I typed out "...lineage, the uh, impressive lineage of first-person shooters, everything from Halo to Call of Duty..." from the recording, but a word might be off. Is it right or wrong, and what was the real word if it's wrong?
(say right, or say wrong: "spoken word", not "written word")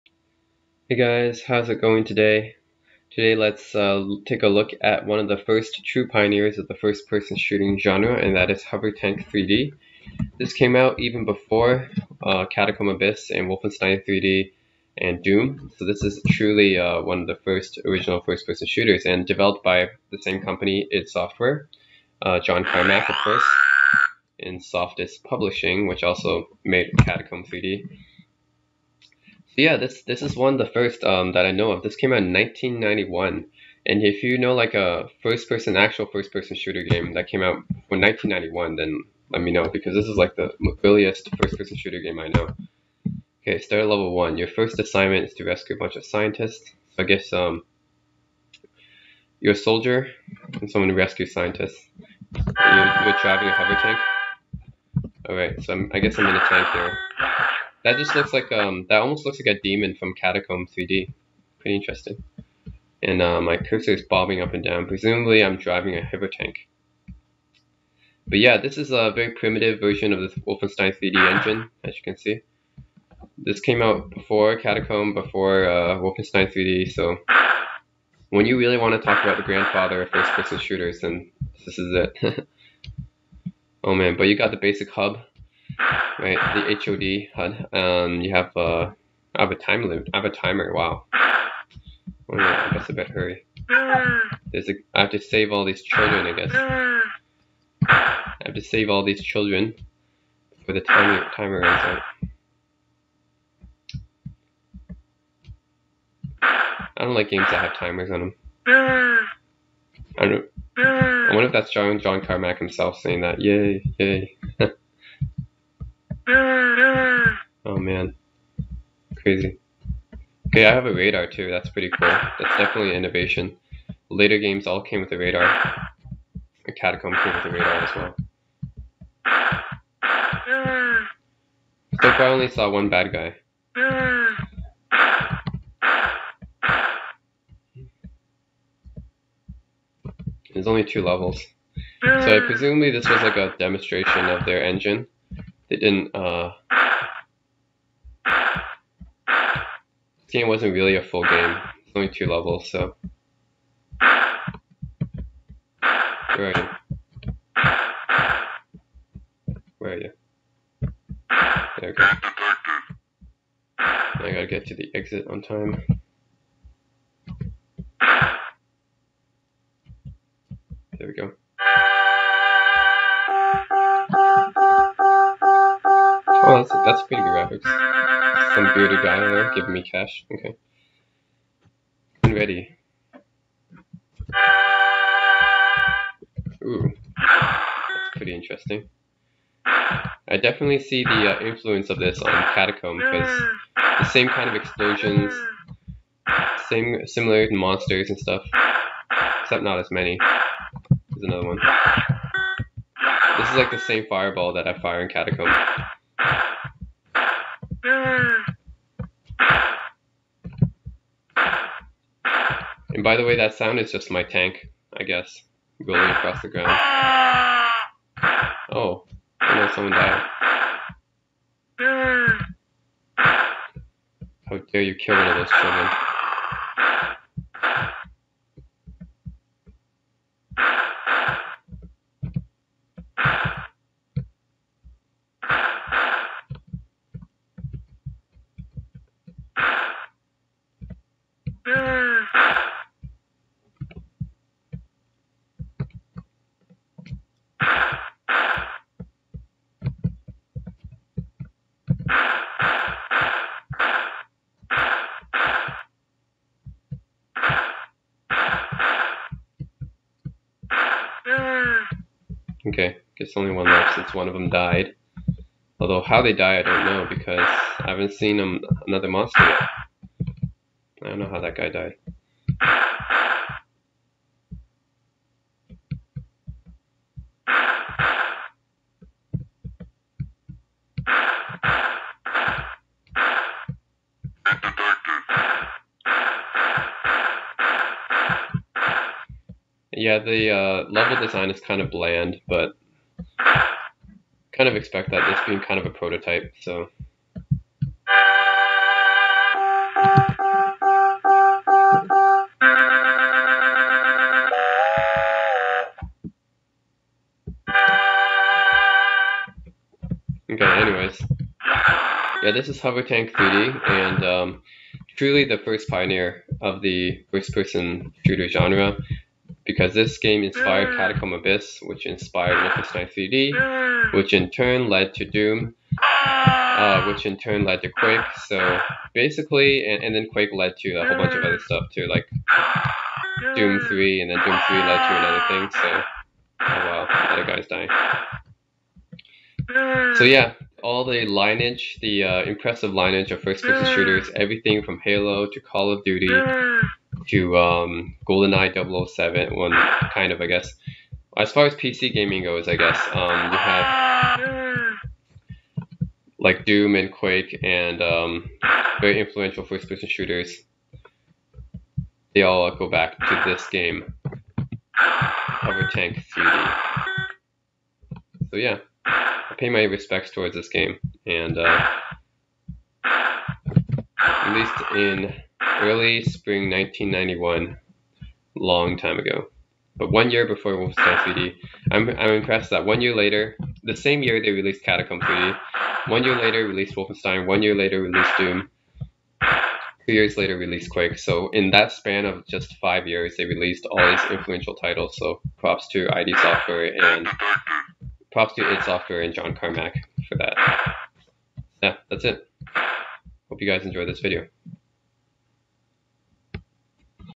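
right.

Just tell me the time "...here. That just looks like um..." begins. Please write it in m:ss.
0:56.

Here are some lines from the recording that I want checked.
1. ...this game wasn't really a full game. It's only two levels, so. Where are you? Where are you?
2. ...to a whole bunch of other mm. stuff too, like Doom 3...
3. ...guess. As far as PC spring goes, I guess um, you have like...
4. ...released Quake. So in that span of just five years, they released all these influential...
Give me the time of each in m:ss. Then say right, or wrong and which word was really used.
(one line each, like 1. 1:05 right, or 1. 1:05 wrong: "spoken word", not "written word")
1. 2:29 right
2. 5:30 right
3. 5:50 wrong: "gaming", not "spring"
4. 6:30 right.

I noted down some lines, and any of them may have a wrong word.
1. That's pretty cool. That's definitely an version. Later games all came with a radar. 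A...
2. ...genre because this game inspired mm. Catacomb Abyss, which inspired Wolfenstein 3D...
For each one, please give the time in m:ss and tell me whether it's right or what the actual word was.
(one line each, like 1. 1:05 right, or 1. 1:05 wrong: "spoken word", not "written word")
1. 2:01 wrong: "innovation", not "version"
2. 5:18 right.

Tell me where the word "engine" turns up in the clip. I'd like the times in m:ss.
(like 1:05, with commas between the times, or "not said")
1:11, 2:24.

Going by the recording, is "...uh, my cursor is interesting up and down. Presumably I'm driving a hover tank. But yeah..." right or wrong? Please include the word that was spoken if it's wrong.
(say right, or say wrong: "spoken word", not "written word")
wrong: "bobbing", not "interesting".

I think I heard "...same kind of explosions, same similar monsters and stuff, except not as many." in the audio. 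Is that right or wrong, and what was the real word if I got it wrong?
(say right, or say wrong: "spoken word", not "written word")
right.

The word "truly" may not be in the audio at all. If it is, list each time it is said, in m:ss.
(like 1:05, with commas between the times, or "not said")
0:16, 5:15.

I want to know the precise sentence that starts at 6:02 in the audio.
They all go back to this game, Hovertank 3D.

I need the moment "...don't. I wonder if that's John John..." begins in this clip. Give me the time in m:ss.
1:50.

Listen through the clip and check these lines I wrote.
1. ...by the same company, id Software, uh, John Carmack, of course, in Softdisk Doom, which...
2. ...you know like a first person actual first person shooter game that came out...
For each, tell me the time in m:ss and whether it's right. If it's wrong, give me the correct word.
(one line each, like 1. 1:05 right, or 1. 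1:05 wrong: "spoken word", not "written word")
1. 0:19 wrong: "Publishing", not "Doom"
2. 0:34 right.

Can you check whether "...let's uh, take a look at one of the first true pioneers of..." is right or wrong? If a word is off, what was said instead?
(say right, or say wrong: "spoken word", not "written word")
right.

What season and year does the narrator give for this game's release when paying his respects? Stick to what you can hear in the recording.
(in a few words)
Early spring 1991.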